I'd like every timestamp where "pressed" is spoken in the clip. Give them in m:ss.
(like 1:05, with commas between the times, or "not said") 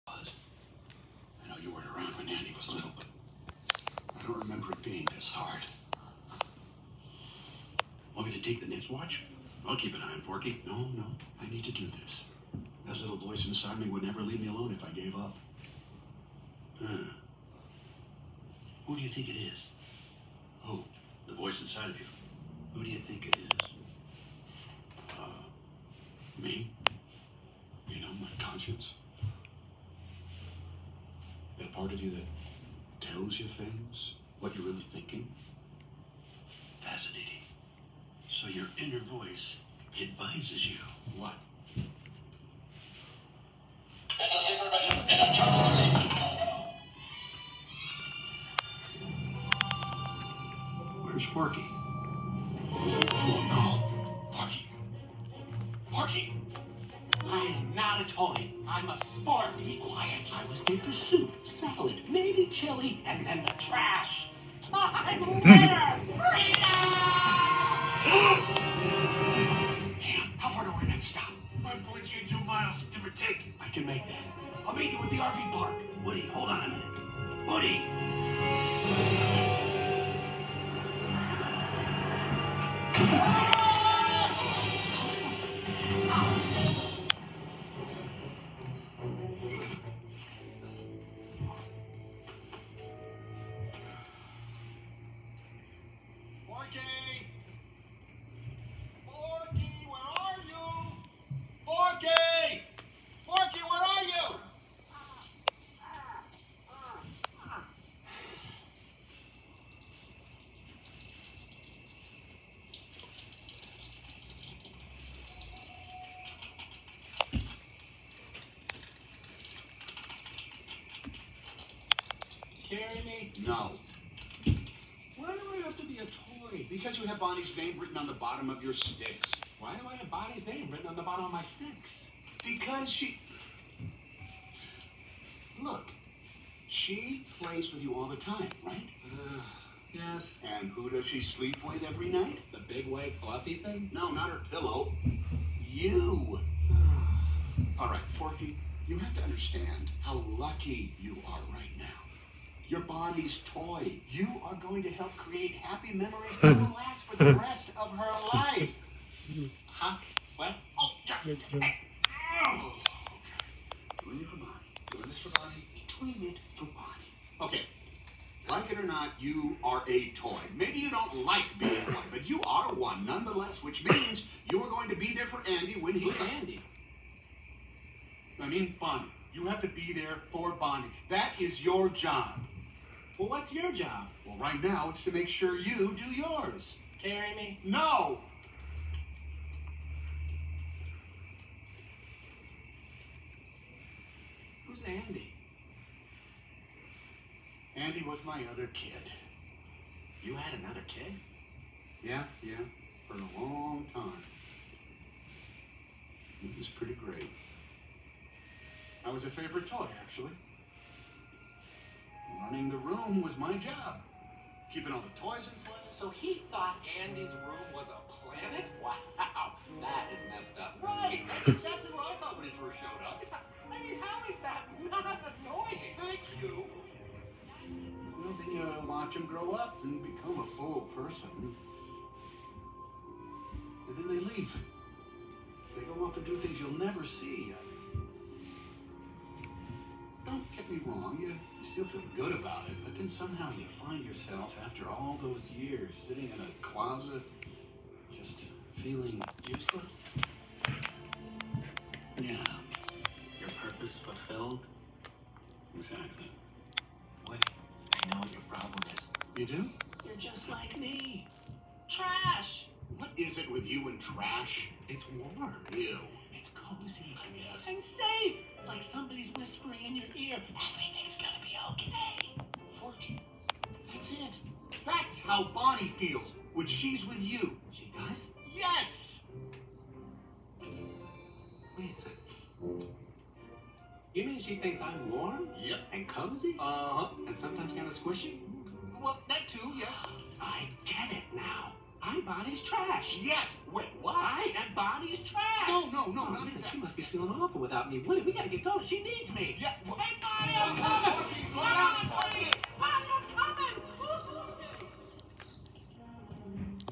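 not said.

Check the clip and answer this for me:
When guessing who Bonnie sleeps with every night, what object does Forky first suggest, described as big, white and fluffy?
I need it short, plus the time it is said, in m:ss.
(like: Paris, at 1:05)
her pillow, at 2:24.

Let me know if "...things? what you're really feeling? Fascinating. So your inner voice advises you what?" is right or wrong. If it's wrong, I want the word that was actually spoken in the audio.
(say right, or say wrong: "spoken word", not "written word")
wrong: "thinking", not "feeling".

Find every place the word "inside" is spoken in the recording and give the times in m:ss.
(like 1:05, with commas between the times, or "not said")
0:13, 0:21.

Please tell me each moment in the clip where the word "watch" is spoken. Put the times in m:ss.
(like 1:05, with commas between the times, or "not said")
0:08, 3:48.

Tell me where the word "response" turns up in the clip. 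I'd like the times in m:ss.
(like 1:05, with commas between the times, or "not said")
not said.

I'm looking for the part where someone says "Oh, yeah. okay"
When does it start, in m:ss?
2:40.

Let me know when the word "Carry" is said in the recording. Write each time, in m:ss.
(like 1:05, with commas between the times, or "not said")
2:02, 3:07.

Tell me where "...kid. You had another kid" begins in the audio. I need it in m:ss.
3:18.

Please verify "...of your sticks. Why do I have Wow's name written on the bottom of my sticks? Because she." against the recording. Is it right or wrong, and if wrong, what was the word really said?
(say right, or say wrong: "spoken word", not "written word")
wrong: "Bonnie", not "Wow".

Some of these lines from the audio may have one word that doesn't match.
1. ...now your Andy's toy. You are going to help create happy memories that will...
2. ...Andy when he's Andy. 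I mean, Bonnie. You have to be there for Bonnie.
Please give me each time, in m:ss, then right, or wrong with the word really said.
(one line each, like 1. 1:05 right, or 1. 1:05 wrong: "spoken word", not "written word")
1. 2:31 wrong: "Bonnie", not "Andy"
2. 2:55 right.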